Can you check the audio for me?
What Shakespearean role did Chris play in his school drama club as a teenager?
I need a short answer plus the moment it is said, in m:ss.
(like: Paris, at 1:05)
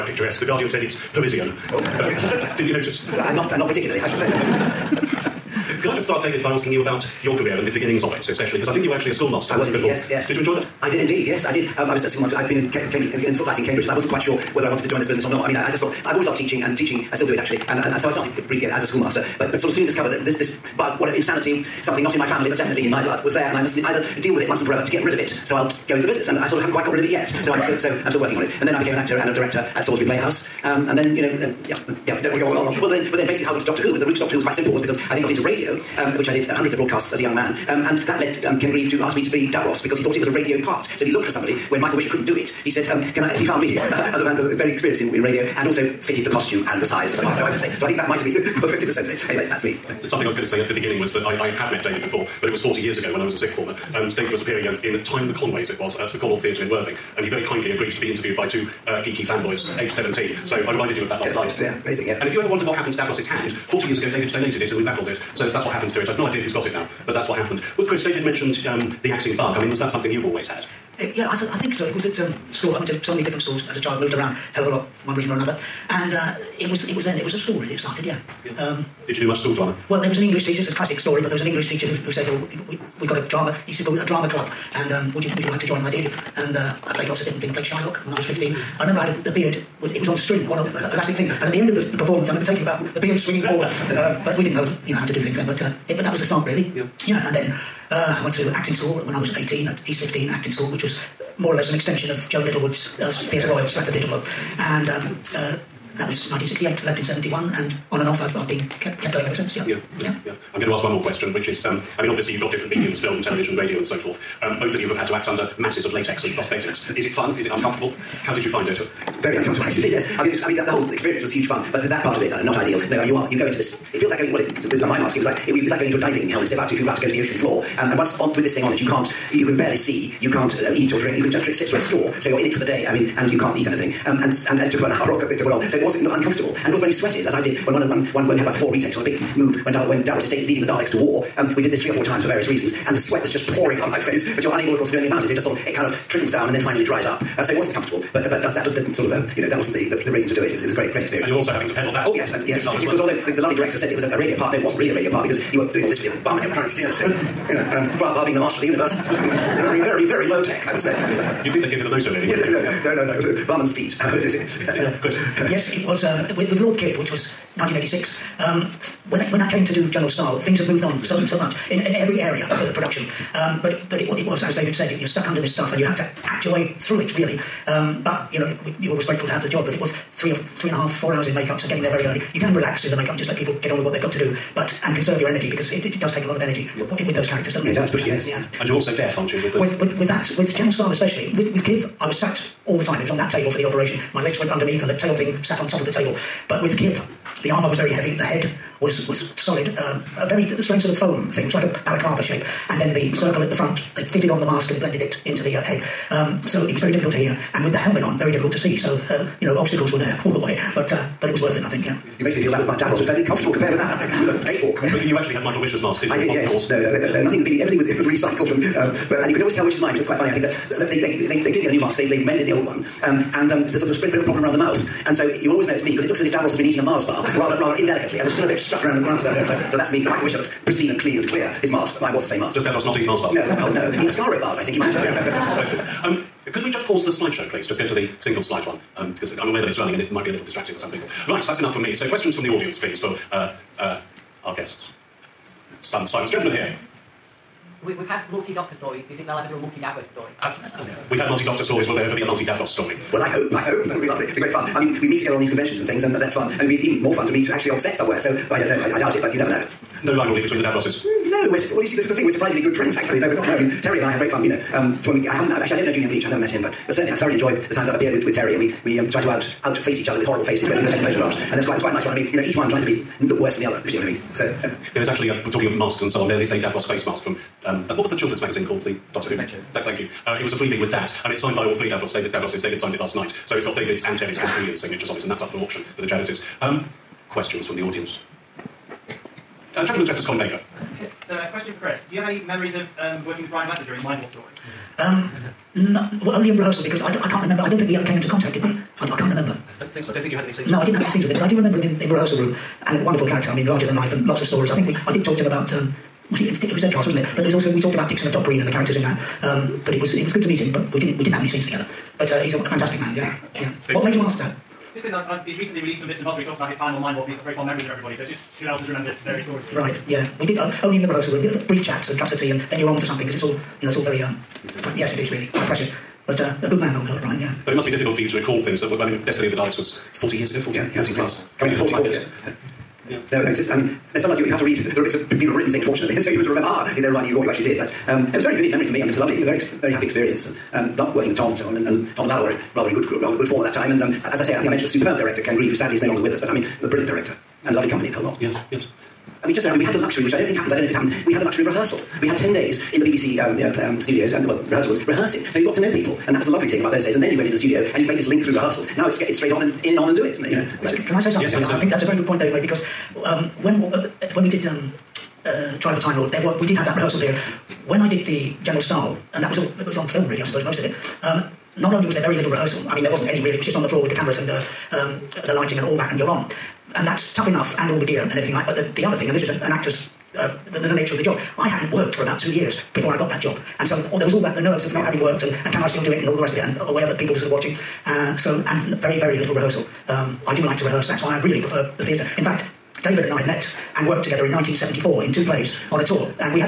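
Shylock, at 1:27.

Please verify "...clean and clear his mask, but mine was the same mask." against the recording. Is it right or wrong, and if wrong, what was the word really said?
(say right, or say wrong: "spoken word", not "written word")
right.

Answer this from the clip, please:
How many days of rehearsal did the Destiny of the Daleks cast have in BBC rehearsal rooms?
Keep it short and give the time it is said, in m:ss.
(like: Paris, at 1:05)
10 days, at 5:52.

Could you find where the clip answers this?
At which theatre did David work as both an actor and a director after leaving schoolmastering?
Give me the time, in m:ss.
0:29.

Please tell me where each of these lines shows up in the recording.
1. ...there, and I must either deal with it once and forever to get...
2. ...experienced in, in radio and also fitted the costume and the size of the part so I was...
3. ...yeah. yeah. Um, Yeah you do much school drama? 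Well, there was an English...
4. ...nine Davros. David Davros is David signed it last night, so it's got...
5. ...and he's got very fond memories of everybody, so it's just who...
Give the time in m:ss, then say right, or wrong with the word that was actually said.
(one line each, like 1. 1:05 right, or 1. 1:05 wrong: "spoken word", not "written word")
1. 0:23 right
2. 0:44 right
3. 1:18 wrong: "Did", not "Yeah"
4. 4:41 wrong: "three", not "nine"
5. 5:17 right.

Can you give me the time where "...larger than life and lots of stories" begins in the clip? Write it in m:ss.
5:03.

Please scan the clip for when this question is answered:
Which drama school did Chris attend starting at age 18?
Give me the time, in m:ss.
1:39.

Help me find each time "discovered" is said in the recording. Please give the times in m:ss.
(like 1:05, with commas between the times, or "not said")
0:19.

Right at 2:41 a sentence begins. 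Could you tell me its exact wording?
You'd think they'd give anything of those Yeah, no, no, yeah.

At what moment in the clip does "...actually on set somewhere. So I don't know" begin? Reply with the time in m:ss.
4:17.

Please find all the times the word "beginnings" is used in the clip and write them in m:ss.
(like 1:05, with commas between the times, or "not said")
0:07, 0:50.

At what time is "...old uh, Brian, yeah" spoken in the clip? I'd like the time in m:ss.
5:26.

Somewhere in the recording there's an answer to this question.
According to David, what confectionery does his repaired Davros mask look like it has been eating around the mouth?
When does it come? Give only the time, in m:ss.
3:46.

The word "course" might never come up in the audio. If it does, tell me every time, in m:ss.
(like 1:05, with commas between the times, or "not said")
2:16, 2:24.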